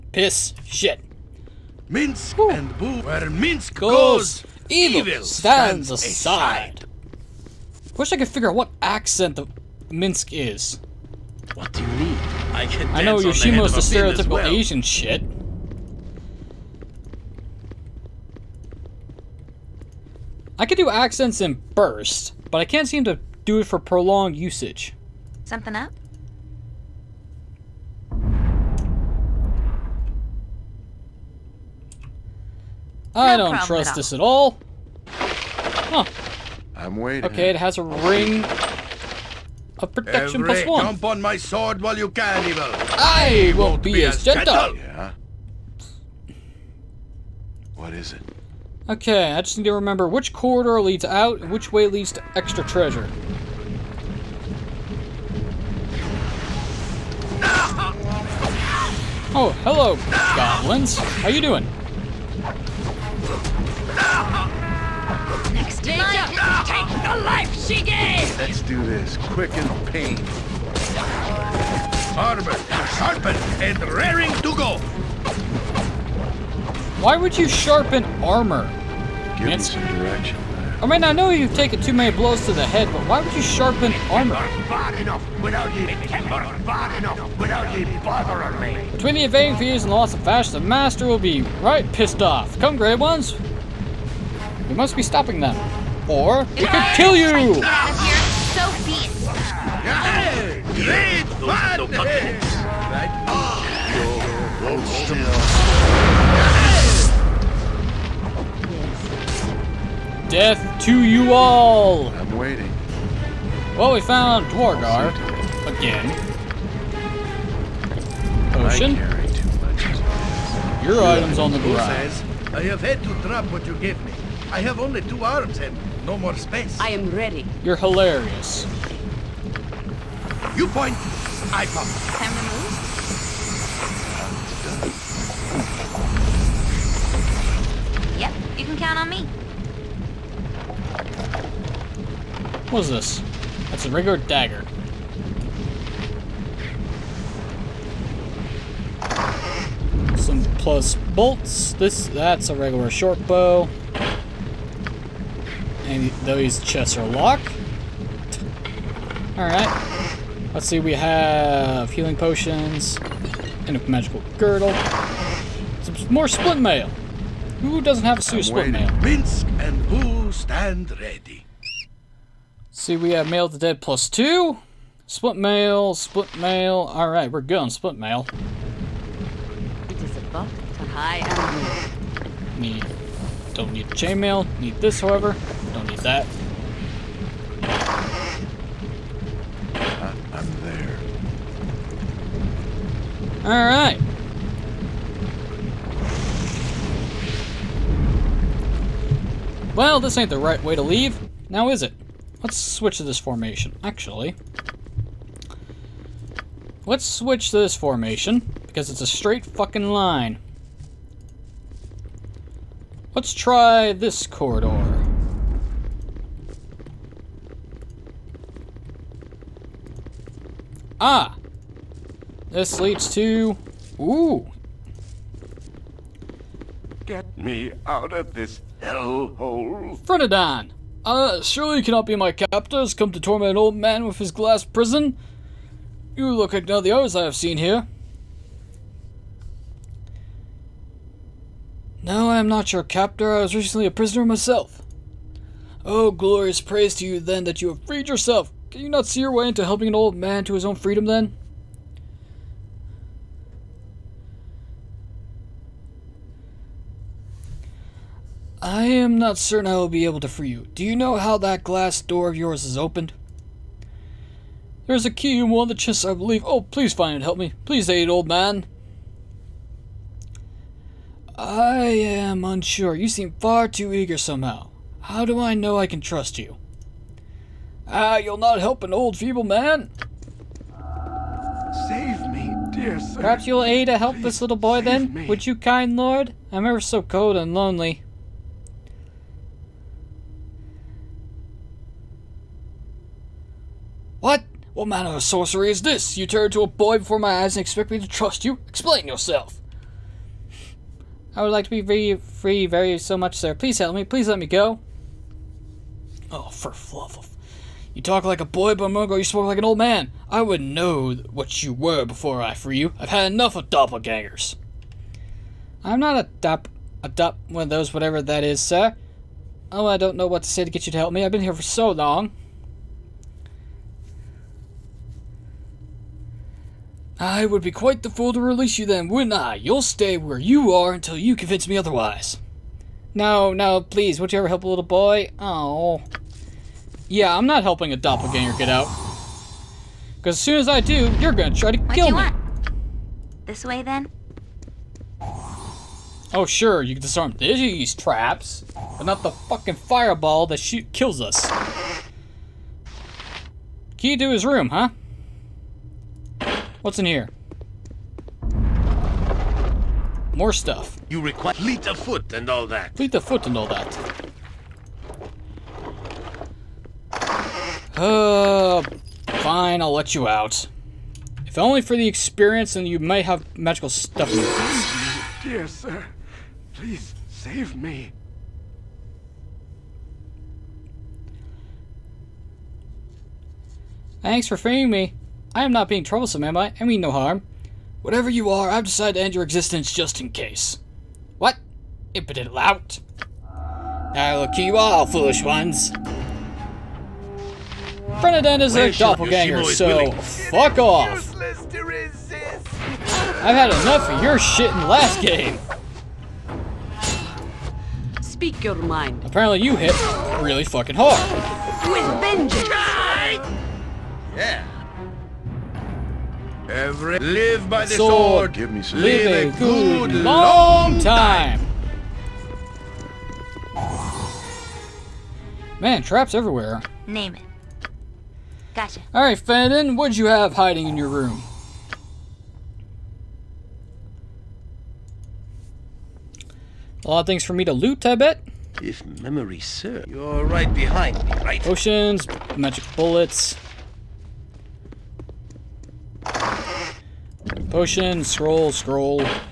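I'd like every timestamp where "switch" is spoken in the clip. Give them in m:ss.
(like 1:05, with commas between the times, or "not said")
3:22, 3:27.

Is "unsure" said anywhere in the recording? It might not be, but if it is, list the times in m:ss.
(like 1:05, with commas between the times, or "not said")
4:32.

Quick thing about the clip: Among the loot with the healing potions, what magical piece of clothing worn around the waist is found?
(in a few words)
Magical girdle.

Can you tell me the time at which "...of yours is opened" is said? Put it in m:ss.
4:22.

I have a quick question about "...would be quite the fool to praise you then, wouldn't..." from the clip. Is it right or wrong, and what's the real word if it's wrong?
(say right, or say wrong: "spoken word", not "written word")
wrong: "release", not "praise".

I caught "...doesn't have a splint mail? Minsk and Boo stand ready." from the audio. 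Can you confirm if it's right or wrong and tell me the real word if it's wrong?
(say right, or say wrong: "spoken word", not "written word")
right.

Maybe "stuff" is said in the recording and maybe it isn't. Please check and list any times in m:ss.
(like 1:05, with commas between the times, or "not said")
6:00, 6:13.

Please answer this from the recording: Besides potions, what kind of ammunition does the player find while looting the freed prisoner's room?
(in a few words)
Magic bullets.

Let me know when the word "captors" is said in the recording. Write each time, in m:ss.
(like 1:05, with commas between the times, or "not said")
3:52, 4:02.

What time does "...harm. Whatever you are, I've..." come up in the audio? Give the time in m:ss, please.
6:27.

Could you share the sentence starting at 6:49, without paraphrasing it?
Apparently you hit really fucking hard.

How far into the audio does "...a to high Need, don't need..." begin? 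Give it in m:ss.
3:00.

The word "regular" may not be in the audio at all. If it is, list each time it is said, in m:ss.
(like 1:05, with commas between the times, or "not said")
2:23, 2:32.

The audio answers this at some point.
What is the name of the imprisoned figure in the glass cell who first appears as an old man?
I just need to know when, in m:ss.
3:50.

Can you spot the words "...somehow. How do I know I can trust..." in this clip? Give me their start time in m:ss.
4:34.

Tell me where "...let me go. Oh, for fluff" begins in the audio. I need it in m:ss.
5:04.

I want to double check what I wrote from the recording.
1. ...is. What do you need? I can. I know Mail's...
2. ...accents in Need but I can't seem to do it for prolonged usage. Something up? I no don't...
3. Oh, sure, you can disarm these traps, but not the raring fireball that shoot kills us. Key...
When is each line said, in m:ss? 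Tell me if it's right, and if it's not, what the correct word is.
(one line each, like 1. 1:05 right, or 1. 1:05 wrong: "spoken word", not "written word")
1. 0:10 wrong: "Yoshimo", not "Mail"
2. 0:20 wrong: "Burst", not "Need"
3. 5:46 wrong: "fucking", not "raring".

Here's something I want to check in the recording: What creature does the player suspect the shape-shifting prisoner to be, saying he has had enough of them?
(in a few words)
Doppelgangers.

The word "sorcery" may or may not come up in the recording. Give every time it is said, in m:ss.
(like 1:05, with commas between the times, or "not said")
4:55.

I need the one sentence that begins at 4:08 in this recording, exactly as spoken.
Can you not see your way into helping an old man to his own freedom, then?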